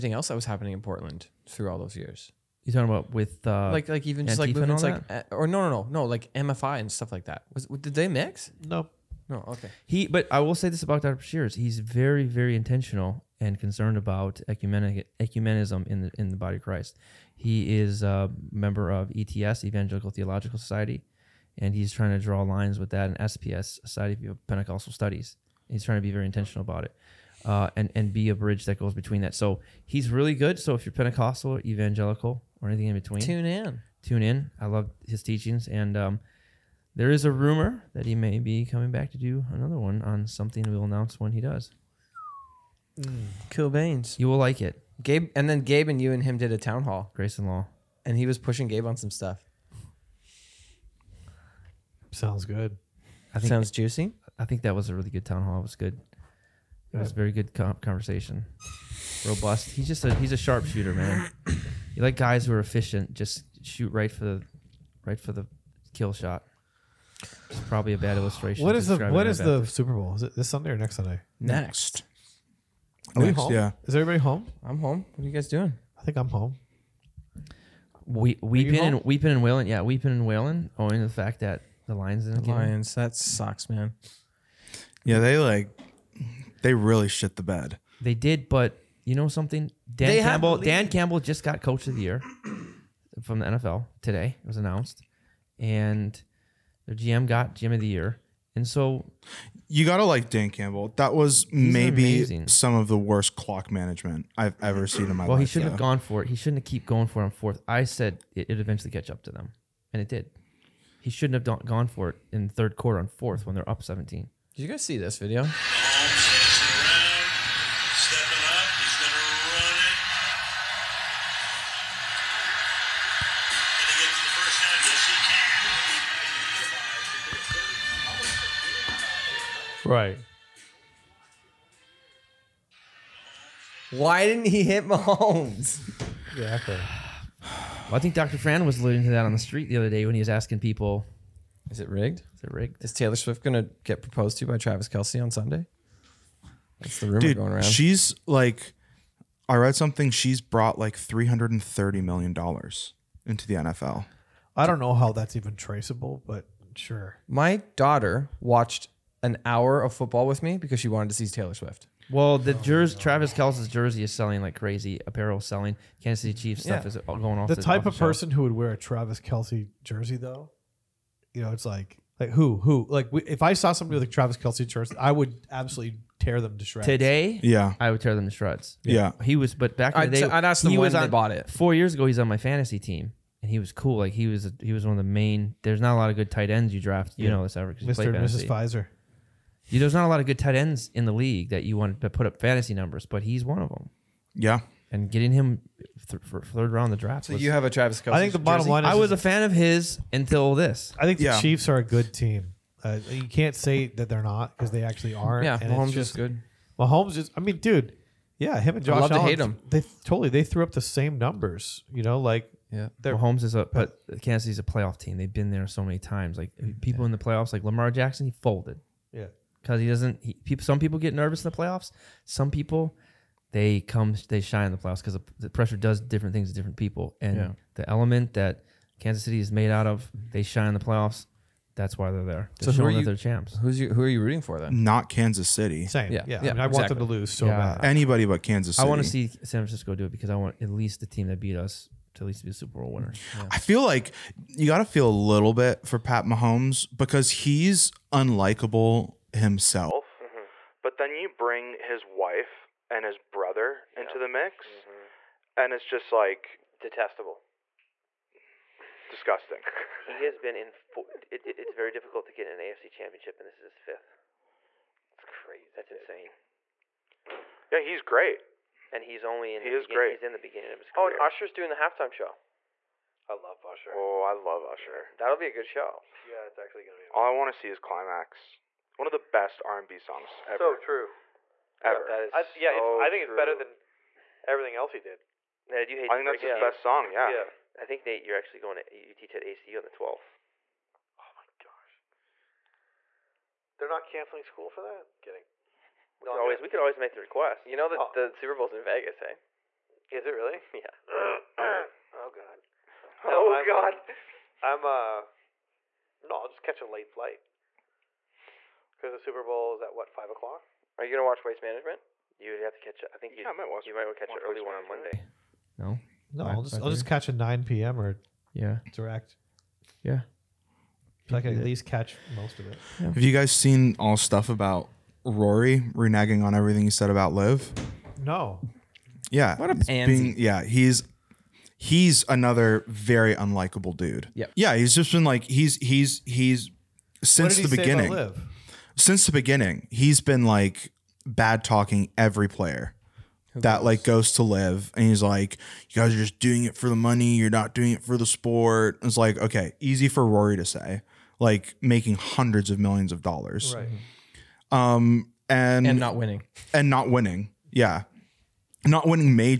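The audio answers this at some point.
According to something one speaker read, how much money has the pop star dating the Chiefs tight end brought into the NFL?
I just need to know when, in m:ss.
2:30.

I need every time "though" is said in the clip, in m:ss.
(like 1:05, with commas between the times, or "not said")
1:45, 2:50.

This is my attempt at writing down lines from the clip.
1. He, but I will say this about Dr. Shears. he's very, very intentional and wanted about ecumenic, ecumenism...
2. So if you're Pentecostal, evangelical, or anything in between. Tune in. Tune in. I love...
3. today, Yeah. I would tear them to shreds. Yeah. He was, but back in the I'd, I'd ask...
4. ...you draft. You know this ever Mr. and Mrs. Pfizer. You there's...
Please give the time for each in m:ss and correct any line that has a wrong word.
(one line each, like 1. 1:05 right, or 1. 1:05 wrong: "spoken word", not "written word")
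1. 0:09 wrong: "concerned", not "wanted"
2. 0:30 right
3. 2:56 right
4. 3:06 right.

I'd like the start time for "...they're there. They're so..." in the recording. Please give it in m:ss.
3:52.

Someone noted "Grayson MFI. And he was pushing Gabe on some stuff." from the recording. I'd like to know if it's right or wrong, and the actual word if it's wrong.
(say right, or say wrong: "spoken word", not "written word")
wrong: "Law", not "MFI".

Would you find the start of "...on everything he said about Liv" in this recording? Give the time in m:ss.
5:26.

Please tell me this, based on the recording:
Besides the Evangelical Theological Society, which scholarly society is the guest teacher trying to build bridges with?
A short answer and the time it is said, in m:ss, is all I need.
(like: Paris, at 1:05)
Society of Pentecostal Studies, at 0:23.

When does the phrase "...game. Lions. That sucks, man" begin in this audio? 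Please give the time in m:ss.
1:22.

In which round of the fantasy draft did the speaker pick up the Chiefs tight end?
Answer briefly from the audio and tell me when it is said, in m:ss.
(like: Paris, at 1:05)
third round, at 3:16.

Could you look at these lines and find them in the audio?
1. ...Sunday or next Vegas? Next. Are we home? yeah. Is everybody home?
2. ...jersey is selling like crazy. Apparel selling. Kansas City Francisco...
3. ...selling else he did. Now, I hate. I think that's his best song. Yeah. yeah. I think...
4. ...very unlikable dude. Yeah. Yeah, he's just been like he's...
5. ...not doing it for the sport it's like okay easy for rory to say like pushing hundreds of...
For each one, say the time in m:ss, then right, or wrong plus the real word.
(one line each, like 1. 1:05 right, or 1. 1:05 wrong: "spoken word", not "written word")
1. 1:10 wrong: "Sunday", not "Vegas"
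2. 2:43 wrong: "Chiefs", not "Francisco"
3. 4:44 wrong: "everything", not "selling"
4. 5:32 right
5. 5:47 wrong: "making", not "pushing".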